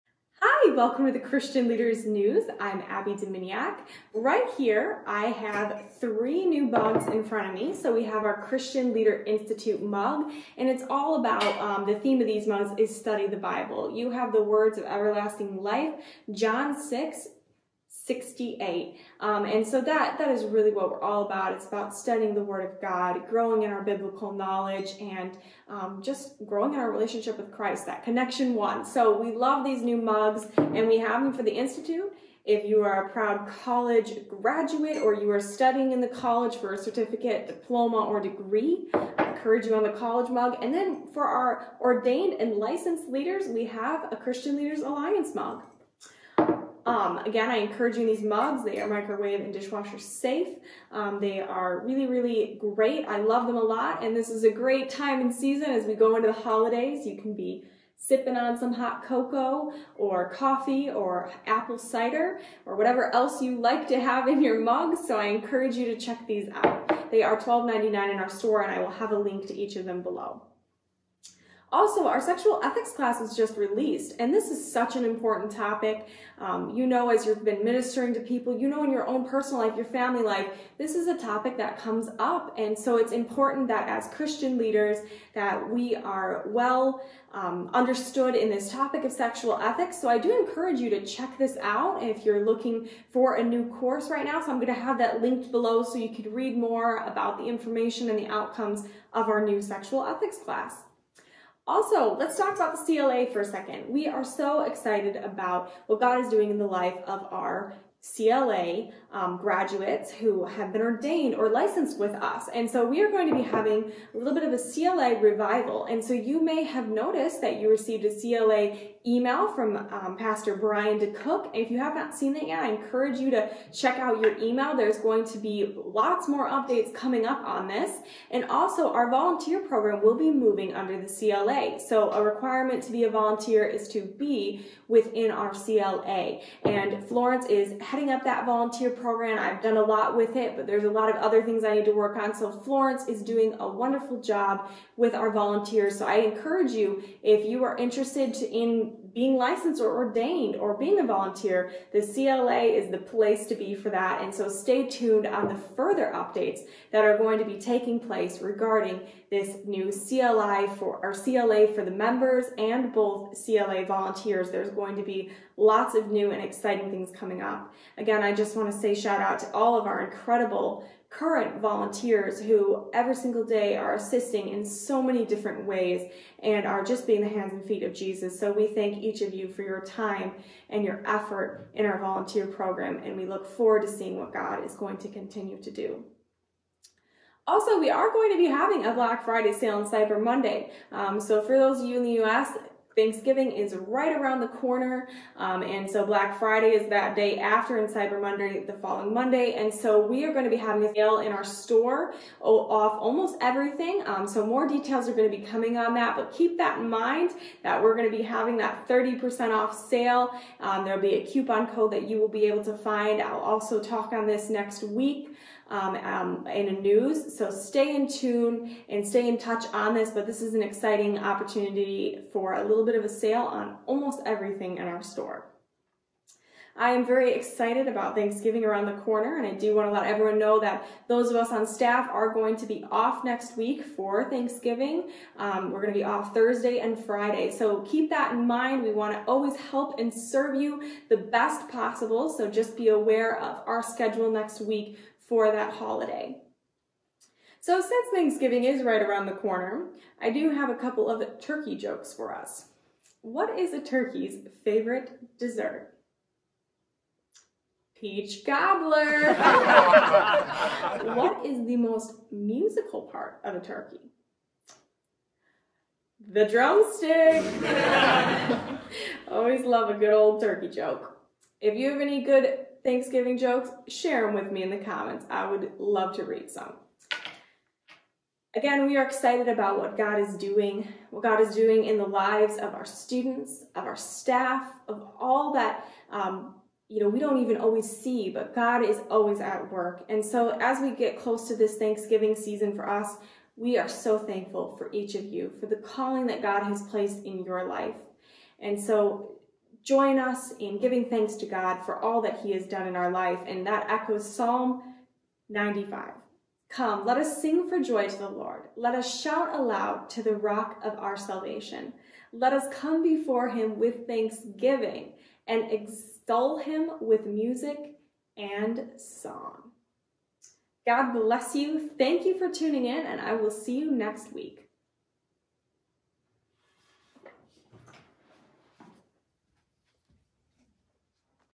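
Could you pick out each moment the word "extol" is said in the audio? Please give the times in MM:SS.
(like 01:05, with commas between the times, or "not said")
05:15.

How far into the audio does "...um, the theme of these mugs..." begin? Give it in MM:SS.
00:11.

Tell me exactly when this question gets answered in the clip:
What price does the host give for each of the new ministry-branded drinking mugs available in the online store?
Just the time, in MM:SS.
01:07.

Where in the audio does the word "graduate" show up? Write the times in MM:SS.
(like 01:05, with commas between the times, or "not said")
00:34, 01:49.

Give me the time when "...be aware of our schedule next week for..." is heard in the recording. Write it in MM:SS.
04:02.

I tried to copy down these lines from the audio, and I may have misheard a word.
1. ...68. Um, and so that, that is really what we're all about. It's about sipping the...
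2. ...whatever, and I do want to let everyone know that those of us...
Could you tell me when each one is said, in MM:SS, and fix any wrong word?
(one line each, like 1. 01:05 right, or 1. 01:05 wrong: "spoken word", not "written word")
1. 00:18 wrong: "studying", not "sipping"
2. 03:49 wrong: "corner", not "whatever".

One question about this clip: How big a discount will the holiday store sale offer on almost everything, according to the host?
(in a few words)
30%.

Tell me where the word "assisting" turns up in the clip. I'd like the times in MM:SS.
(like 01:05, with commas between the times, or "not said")
02:53.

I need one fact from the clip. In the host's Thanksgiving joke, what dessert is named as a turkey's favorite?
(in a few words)
Peach Gobbler.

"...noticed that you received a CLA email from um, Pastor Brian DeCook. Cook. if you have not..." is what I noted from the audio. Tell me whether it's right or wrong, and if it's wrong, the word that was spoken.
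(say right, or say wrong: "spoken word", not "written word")
right.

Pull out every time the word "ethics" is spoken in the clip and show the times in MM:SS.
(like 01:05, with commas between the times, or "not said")
01:12, 01:29, 01:40.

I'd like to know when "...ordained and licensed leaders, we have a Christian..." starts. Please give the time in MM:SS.
00:41.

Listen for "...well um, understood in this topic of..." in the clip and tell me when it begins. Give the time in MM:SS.
01:26.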